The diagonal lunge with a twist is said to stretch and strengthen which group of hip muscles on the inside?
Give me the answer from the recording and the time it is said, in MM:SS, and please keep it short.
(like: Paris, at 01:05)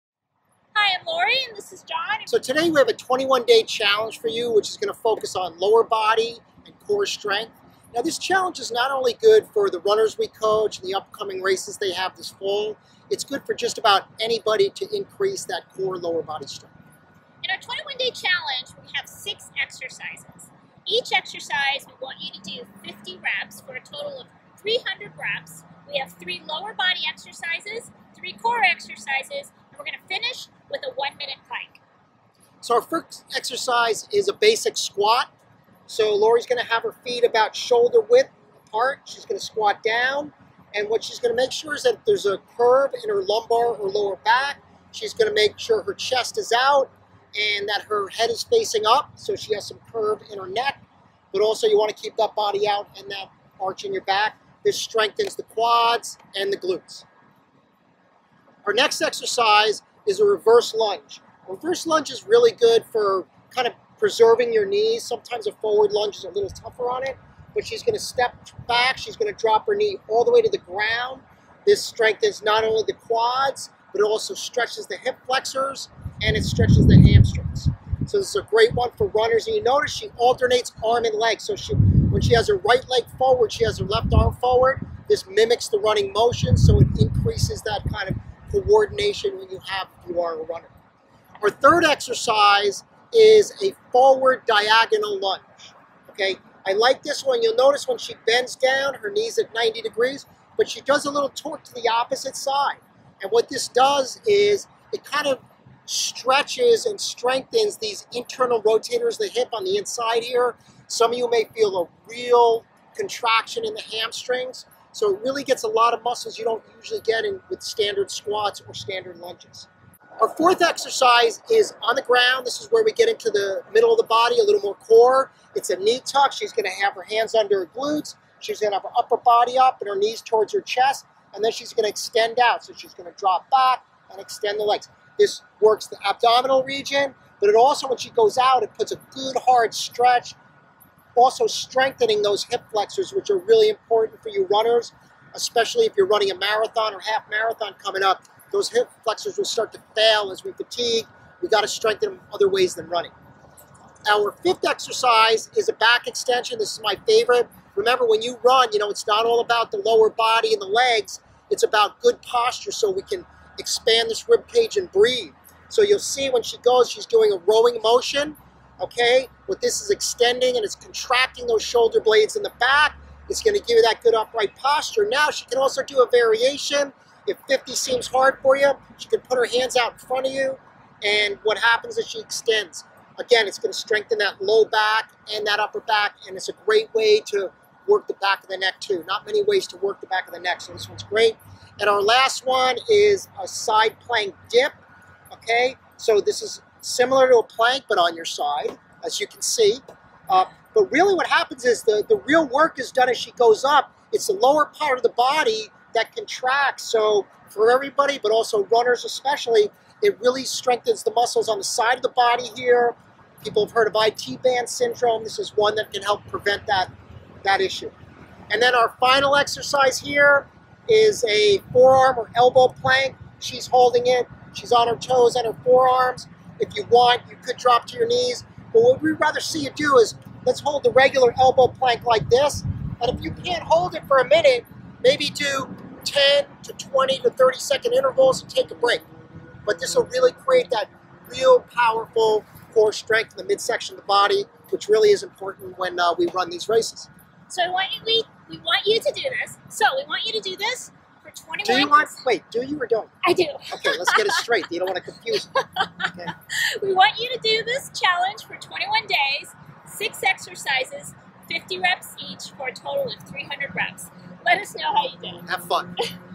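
Internal rotators, at 01:48.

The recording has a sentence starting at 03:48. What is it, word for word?
But what we'd rather see you do is let's hold the regular elbow plank like this.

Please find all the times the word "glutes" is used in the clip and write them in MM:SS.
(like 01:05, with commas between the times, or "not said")
00:56, 02:07.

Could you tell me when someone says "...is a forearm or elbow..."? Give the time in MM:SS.
03:40.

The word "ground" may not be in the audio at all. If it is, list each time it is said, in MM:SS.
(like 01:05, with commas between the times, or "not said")
01:10, 02:02.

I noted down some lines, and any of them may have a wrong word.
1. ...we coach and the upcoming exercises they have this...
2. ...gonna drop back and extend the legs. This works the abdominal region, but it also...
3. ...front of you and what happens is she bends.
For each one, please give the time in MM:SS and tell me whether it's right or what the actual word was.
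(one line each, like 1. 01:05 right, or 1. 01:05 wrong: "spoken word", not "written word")
1. 00:10 wrong: "races", not "exercises"
2. 02:12 right
3. 02:59 wrong: "extends", not "bends".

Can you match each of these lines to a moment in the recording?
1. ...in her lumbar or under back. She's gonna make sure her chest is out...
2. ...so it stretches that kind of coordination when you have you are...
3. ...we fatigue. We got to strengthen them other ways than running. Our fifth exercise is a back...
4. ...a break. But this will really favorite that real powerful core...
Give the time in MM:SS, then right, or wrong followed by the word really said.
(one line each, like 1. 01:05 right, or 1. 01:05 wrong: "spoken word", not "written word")
1. 00:43 wrong: "lower", not "under"
2. 01:26 wrong: "increases", not "stretches"
3. 02:30 right
4. 03:58 wrong: "create", not "favorite".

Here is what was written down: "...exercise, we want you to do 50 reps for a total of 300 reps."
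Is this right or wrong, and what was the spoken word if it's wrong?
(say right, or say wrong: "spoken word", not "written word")
right.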